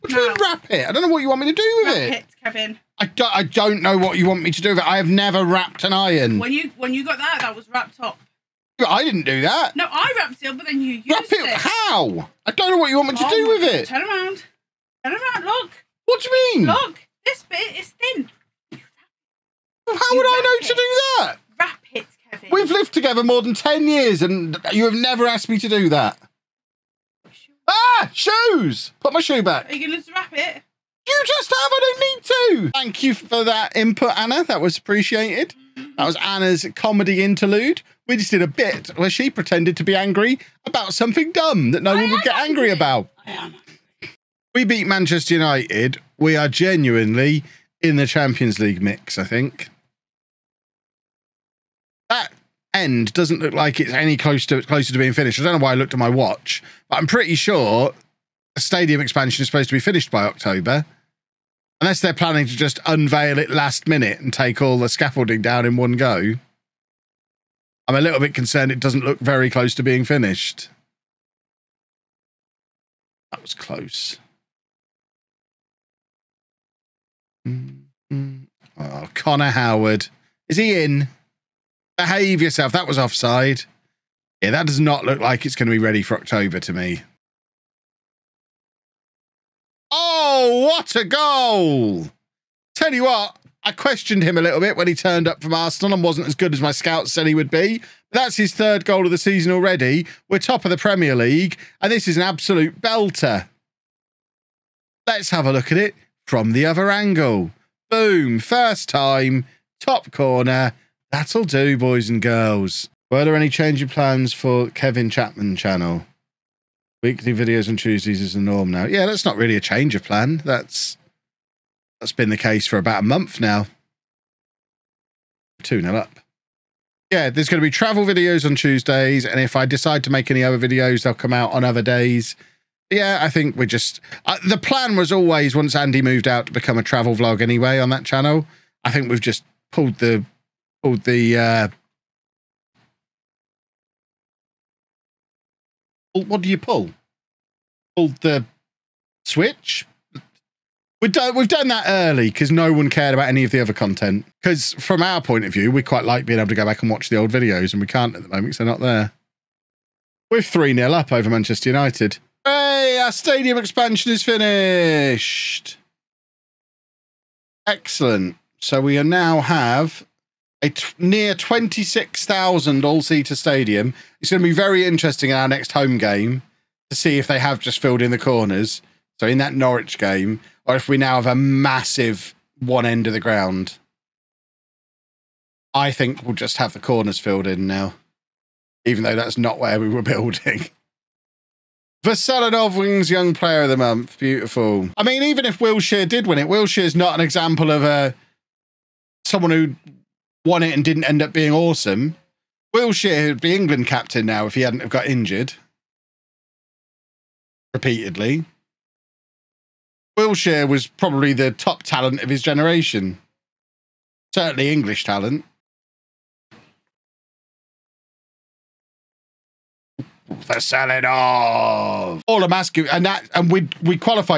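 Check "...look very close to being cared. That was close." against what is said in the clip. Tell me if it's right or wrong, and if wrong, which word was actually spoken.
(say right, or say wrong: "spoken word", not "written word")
wrong: "finished", not "cared".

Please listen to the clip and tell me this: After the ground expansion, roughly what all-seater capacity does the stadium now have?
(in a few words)
26,000.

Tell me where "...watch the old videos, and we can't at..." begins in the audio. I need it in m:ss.
2:36.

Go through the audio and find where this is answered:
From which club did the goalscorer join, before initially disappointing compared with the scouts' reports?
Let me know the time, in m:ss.
1:35.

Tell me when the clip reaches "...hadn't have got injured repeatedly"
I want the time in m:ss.
3:24.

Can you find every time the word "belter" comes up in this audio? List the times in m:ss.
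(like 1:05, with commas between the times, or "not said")
1:42.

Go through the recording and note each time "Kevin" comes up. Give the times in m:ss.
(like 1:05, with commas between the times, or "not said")
0:02, 1:54.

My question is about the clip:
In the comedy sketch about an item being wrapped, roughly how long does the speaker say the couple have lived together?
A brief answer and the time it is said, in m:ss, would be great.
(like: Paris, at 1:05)
more than 10 years, at 0:23.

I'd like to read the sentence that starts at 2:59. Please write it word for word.
So, in that Norwich game, or if we now have a massive one end of the ground.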